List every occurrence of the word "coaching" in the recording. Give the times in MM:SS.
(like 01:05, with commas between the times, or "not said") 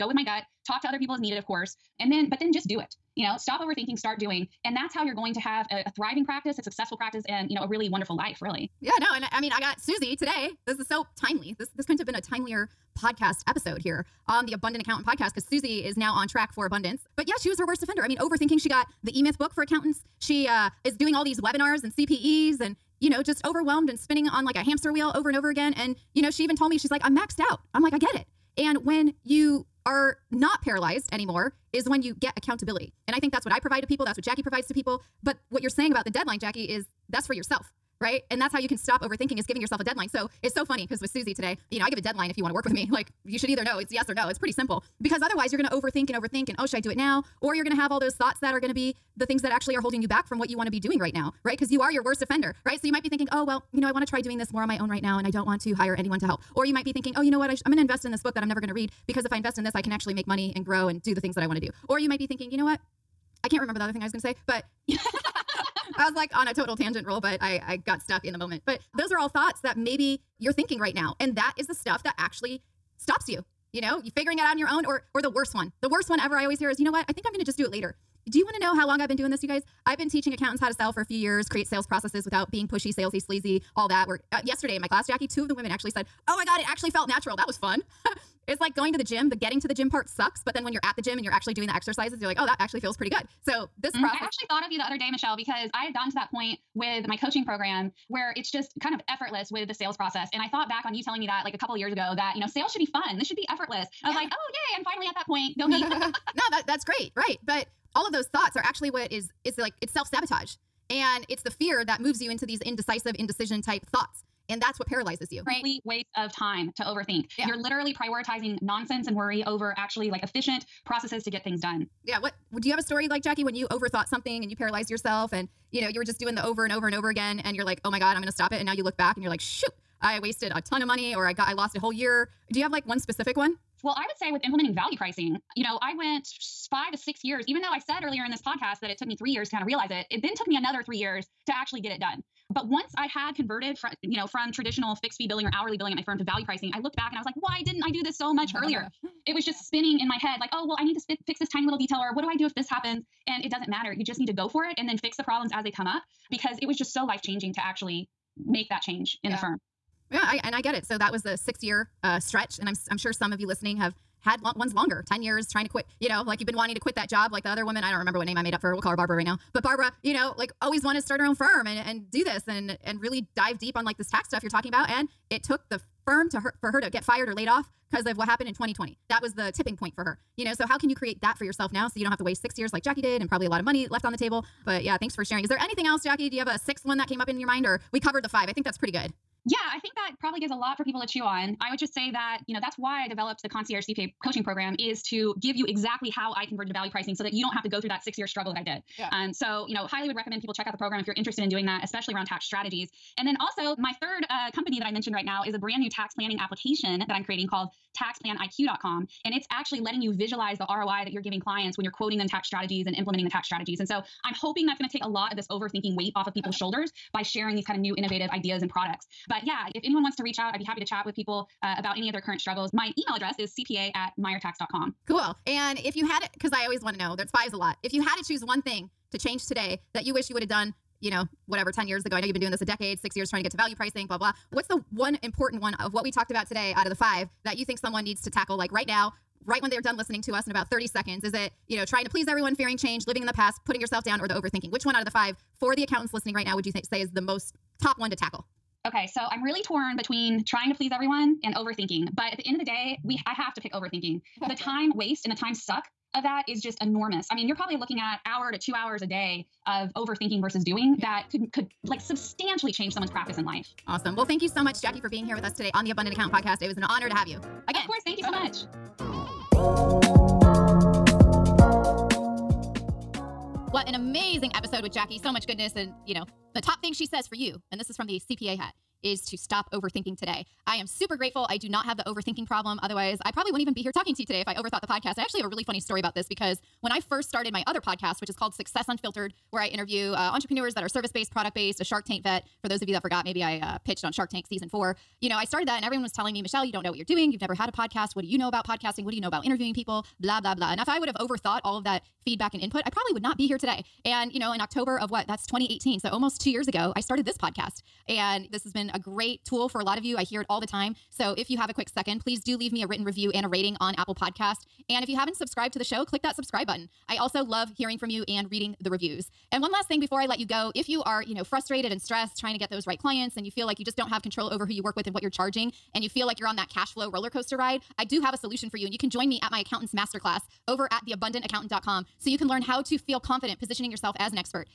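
01:37, 03:14.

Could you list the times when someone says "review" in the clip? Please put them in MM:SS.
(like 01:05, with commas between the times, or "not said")
05:13, 05:18.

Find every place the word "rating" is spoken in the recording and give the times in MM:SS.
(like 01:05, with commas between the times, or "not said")
05:13.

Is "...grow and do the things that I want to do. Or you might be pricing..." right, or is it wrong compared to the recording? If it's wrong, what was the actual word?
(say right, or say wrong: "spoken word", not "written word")
wrong: "thinking", not "pricing".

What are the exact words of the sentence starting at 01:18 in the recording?
Do you want to know how long I've been doing this, you guys?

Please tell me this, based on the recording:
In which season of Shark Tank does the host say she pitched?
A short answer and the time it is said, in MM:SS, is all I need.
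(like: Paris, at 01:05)
Season 4, at 04:54.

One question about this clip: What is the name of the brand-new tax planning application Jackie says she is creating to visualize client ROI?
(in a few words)
taxplaniq.com.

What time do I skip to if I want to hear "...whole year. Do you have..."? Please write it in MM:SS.
02:11.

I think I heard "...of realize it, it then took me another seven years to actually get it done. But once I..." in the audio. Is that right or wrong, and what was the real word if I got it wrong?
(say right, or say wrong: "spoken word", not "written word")
wrong: "three", not "seven".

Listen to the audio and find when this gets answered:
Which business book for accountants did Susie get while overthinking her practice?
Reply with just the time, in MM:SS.
00:19.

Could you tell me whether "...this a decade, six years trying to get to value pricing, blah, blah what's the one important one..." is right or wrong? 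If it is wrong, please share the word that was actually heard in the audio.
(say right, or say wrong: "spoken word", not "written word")
right.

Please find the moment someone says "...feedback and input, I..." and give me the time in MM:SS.
05:02.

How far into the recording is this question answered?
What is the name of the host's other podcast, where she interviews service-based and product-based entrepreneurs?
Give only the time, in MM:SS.
04:48.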